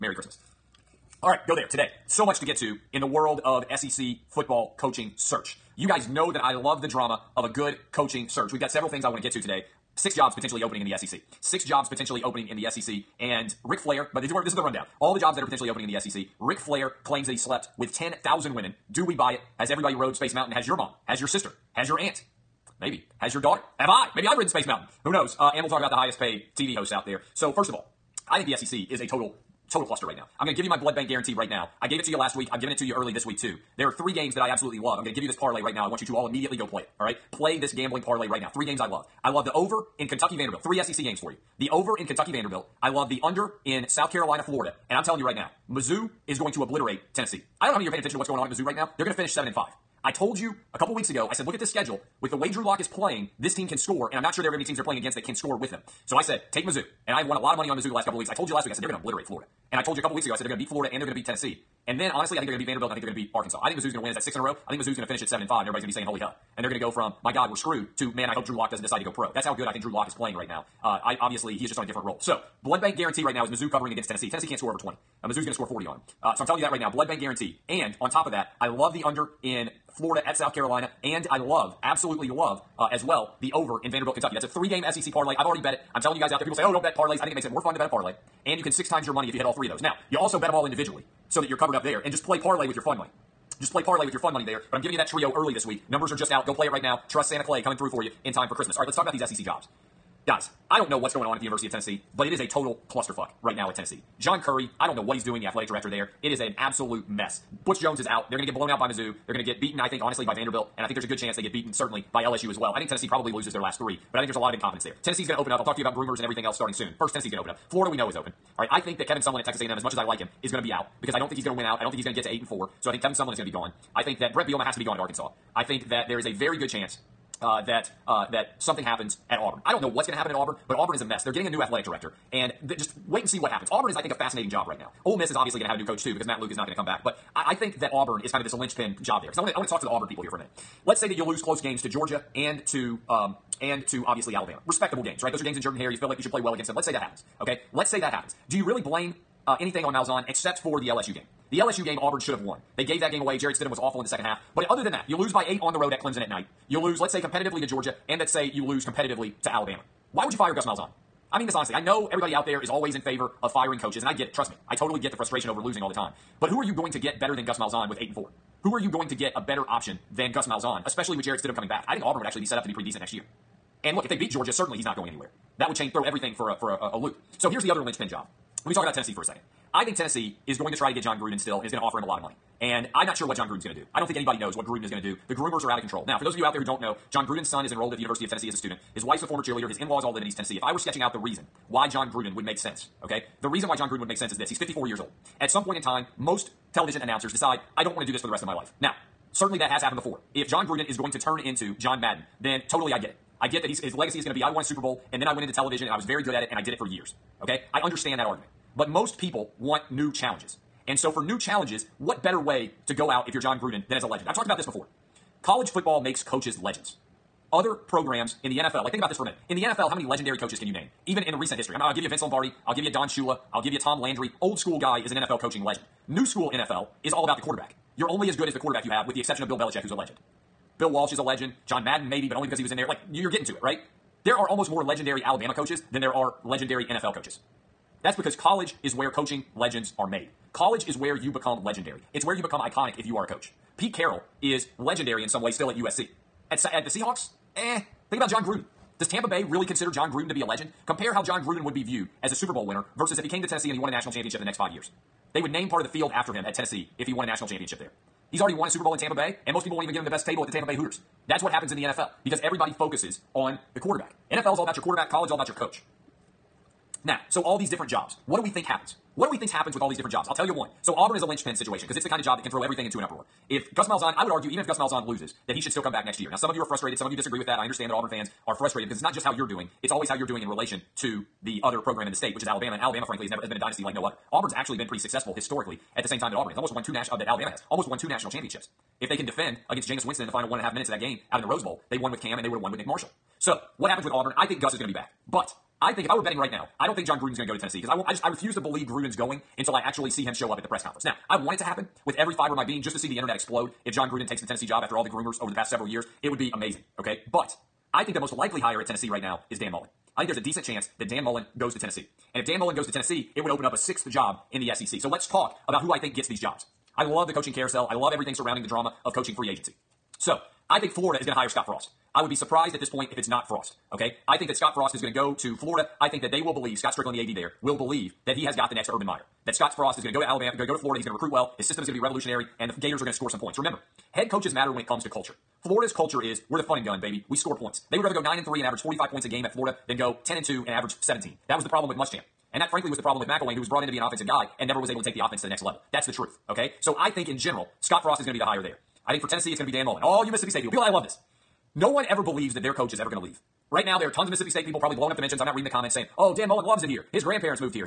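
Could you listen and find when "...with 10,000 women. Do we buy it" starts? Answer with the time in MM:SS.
00:17.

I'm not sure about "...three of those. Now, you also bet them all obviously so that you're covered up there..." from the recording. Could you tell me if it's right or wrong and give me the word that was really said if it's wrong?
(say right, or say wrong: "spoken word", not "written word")
wrong: "individually", not "obviously".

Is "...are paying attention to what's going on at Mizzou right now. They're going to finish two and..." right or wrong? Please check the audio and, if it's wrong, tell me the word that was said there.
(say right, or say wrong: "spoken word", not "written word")
wrong: "seven", not "two".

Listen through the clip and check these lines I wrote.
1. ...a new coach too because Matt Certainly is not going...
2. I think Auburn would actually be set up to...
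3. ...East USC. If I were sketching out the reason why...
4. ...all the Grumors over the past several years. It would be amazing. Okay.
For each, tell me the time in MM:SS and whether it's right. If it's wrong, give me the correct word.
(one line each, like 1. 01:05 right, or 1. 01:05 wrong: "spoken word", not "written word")
1. 02:15 wrong: "Luke", not "Certainly"
2. 02:51 right
3. 03:10 wrong: "Tennessee", not "USC"
4. 05:04 right.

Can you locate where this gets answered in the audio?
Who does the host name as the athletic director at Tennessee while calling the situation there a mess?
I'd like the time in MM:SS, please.
01:44.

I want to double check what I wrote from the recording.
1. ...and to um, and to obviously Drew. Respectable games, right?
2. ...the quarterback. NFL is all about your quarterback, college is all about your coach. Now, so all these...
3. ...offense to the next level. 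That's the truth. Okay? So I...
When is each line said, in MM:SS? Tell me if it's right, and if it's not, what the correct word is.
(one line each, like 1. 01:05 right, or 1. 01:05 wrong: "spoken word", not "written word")
1. 02:22 wrong: "Alabama", not "Drew"
2. 04:23 right
3. 05:45 right.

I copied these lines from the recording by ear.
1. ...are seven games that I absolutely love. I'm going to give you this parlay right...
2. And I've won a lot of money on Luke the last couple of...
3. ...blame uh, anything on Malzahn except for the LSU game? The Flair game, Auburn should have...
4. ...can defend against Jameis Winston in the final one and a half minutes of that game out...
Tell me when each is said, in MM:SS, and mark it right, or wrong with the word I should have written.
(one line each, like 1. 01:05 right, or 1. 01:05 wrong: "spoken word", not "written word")
1. 00:33 wrong: "three", not "seven"
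2. 00:57 wrong: "Mizzou", not "Luke"
3. 02:28 wrong: "LSU", not "Flair"
4. 04:49 right.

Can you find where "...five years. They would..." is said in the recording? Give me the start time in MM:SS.
04:14.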